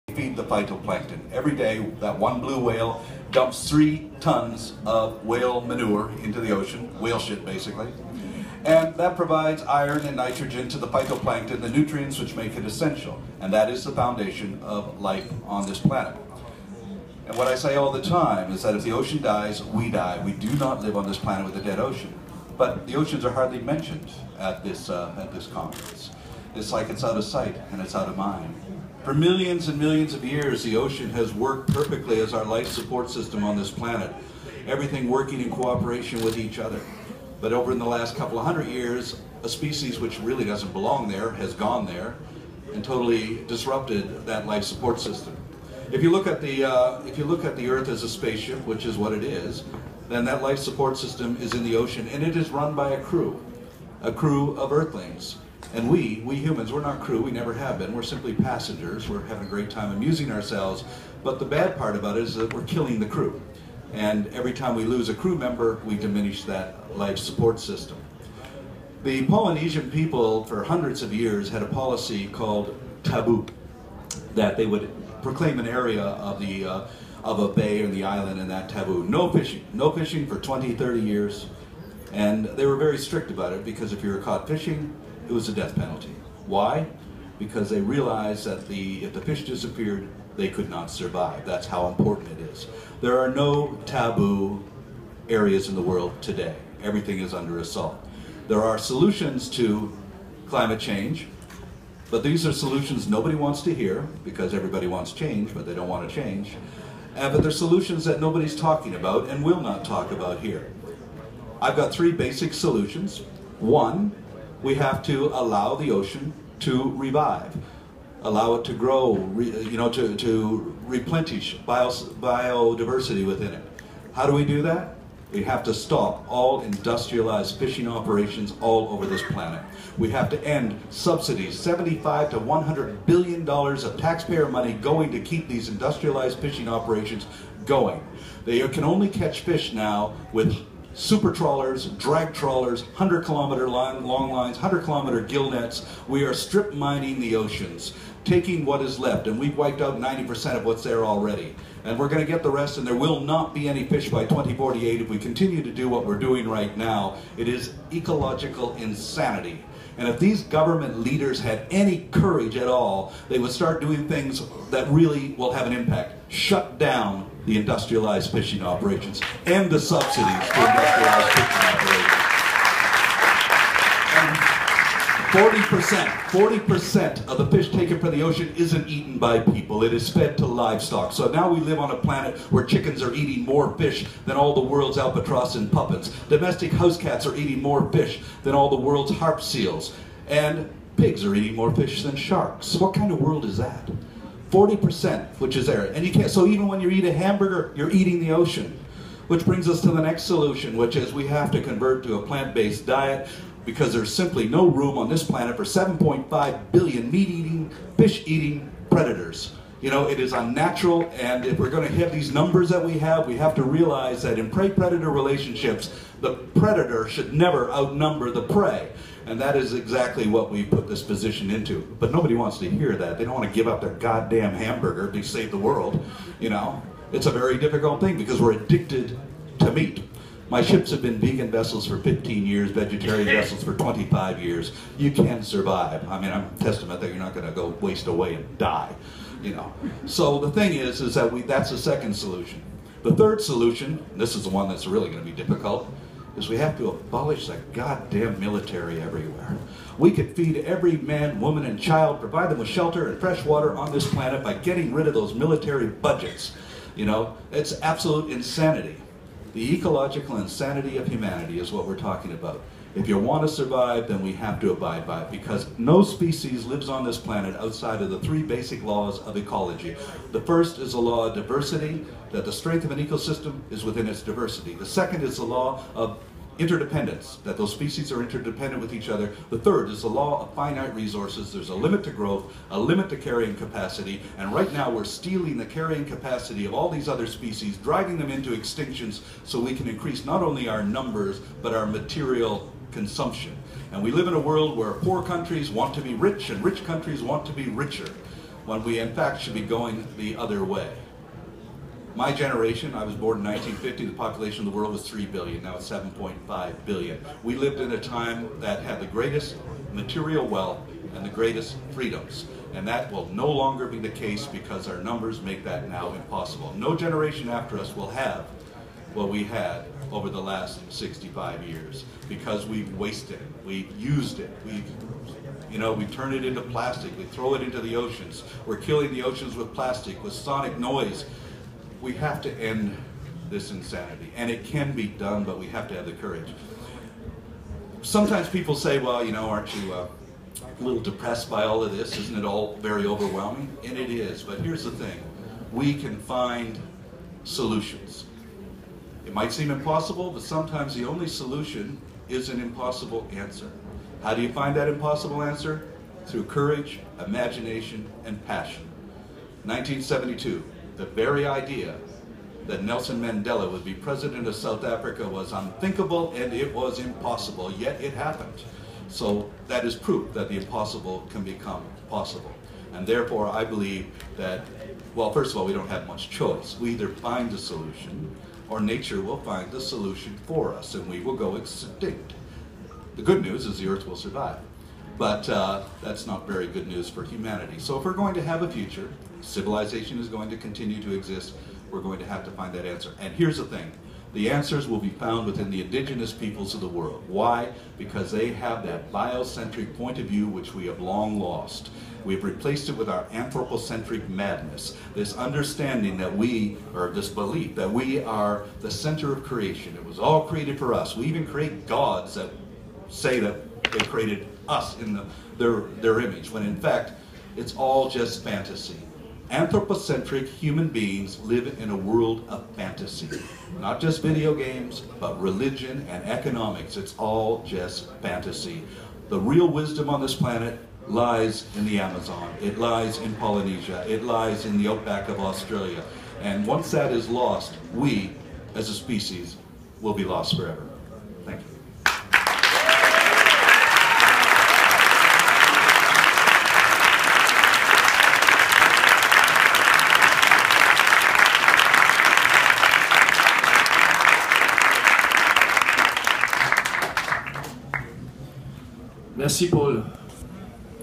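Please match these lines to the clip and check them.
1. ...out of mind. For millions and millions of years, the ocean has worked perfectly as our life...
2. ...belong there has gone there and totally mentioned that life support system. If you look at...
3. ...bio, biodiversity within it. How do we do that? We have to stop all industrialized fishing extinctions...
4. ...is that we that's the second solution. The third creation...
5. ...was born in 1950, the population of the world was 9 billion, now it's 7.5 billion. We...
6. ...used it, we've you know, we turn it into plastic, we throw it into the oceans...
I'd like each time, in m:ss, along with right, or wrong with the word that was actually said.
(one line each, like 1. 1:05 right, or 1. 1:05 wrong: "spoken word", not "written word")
1. 0:27 right
2. 0:40 wrong: "disrupted", not "mentioned"
3. 2:01 wrong: "operations", not "extinctions"
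4. 4:01 wrong: "solution", not "creation"
5. 5:03 wrong: "3", not "9"
6. 5:23 right.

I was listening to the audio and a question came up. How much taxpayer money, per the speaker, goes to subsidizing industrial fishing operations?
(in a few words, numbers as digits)
75 to 100 billion dollars.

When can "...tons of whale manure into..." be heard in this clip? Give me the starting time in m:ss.
0:04.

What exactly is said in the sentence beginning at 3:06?
Domestic house cats are eating more fish than all the world's harp seals.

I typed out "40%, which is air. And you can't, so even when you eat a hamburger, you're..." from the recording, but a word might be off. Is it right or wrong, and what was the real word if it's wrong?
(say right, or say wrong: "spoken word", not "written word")
right.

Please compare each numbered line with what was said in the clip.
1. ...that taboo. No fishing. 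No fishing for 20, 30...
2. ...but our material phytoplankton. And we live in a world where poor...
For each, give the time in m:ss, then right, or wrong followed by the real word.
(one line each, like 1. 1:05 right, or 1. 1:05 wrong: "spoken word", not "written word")
1. 1:18 right
2. 4:51 wrong: "consumption", not "phytoplankton".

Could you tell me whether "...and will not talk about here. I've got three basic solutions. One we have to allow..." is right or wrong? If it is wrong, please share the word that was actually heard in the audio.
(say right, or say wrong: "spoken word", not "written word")
right.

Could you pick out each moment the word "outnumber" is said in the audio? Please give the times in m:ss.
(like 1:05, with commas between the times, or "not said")
3:37.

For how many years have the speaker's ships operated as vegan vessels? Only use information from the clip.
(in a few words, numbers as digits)
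15 years.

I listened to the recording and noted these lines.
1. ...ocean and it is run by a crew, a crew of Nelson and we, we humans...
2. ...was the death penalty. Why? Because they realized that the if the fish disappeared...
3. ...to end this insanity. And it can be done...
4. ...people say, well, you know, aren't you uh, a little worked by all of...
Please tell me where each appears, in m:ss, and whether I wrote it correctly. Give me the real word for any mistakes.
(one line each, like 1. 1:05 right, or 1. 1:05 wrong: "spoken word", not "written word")
1. 0:51 wrong: "Earthlings", not "Nelson"
2. 1:25 right
3. 5:32 right
4. 5:38 wrong: "depressed", not "worked".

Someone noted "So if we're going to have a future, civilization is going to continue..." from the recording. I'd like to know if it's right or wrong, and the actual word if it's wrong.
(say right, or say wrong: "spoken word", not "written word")
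right.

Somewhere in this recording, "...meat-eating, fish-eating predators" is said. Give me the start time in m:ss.
3:27.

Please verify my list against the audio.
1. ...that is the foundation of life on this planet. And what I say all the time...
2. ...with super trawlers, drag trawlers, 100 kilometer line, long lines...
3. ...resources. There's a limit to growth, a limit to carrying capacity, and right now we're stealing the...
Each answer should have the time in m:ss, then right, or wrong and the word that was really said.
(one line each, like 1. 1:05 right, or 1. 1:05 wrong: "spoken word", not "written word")
1. 0:13 right
2. 2:20 right
3. 4:40 right.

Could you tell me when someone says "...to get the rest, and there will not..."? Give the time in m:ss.
2:32.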